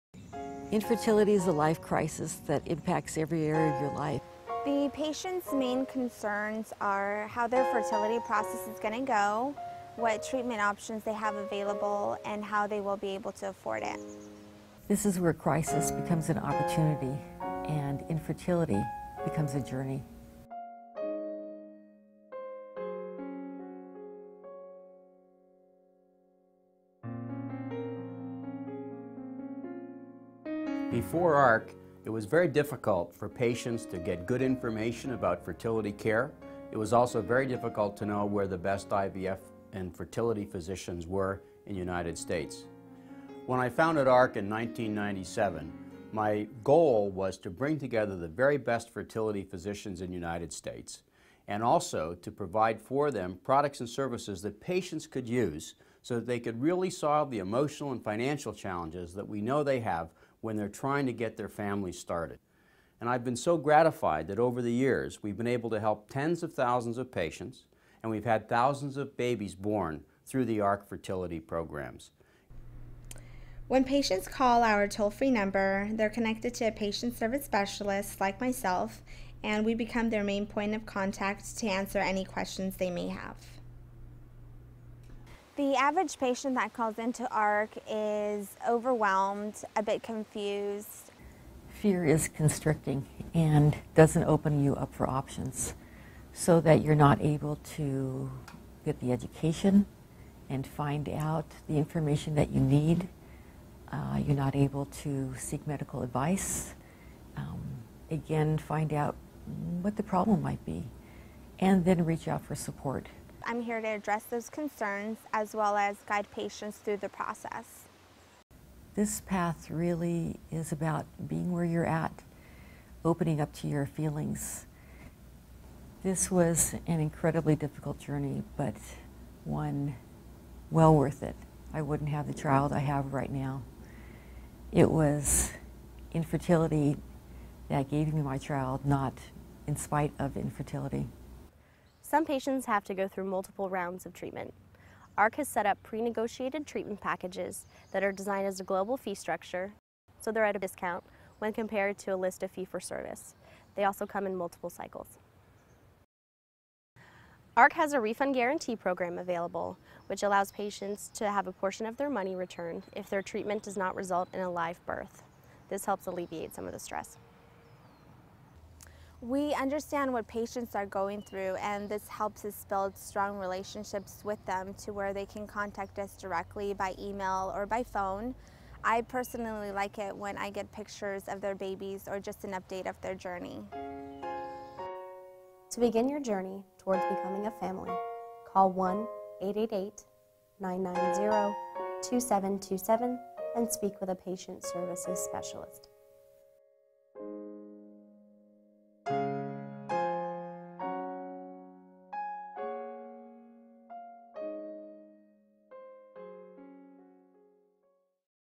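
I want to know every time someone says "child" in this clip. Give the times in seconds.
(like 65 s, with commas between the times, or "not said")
132 s, 138 s.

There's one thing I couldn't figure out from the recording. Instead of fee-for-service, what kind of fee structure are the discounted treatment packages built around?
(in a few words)
global fee structure.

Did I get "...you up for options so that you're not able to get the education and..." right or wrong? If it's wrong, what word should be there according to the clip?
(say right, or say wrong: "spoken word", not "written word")
right.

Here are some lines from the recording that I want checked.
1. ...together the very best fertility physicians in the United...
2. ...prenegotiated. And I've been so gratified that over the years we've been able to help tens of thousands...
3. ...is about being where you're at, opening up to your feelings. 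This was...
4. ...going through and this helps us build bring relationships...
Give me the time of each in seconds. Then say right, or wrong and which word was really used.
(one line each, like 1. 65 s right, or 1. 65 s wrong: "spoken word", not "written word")
1. 47 s right
2. 61 s wrong: "started", not "prenegotiated"
3. 120 s right
4. 170 s wrong: "strong", not "bring".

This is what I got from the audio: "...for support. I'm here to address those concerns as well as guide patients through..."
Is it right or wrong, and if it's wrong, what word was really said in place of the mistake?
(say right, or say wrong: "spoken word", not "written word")
right.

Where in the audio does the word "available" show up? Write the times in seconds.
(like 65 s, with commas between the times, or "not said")
11 s, 159 s.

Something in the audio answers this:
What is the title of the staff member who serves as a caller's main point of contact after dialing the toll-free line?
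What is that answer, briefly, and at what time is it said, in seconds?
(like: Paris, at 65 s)
patient service specialist, at 76 s.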